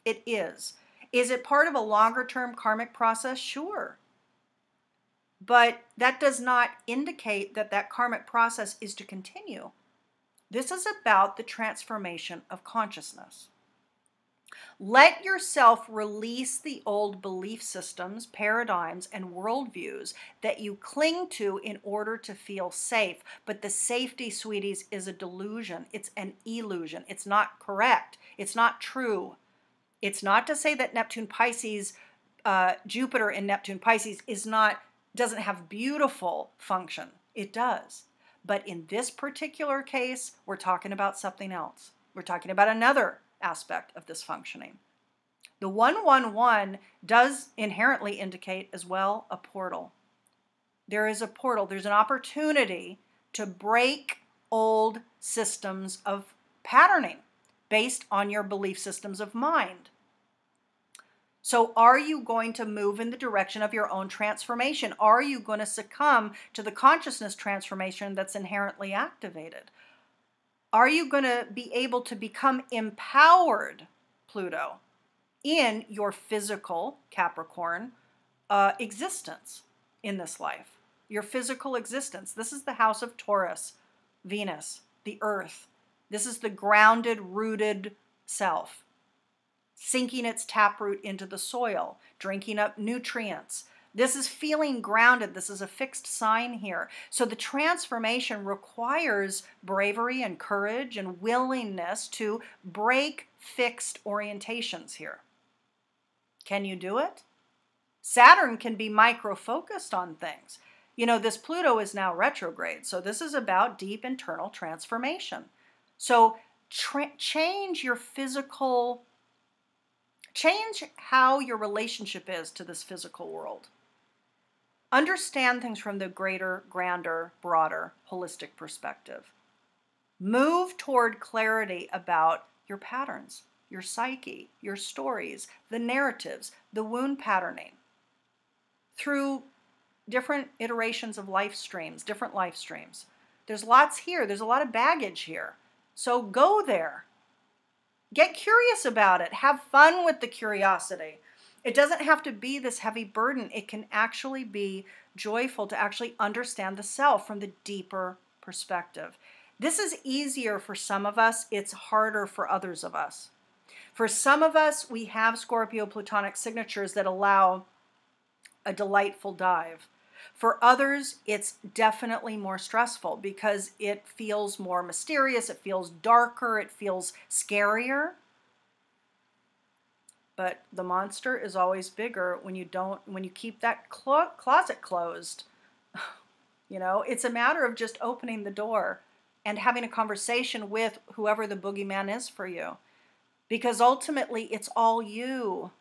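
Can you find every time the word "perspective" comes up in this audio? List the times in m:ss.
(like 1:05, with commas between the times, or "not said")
2:08, 2:38.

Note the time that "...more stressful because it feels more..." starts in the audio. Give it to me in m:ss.
2:52.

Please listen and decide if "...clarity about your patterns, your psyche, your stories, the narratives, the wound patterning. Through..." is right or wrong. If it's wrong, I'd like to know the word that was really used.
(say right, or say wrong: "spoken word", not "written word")
right.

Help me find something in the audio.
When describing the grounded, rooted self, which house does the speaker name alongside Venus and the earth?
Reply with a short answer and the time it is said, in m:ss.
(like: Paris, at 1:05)
Taurus, at 1:22.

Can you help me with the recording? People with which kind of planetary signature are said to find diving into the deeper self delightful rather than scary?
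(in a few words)
Scorpio Plutonic signatures.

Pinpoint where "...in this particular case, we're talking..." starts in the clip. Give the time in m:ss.
0:38.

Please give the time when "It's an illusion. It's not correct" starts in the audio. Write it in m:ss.
0:25.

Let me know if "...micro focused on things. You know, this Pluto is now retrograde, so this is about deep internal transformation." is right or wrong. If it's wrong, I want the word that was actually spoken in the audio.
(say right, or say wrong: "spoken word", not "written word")
right.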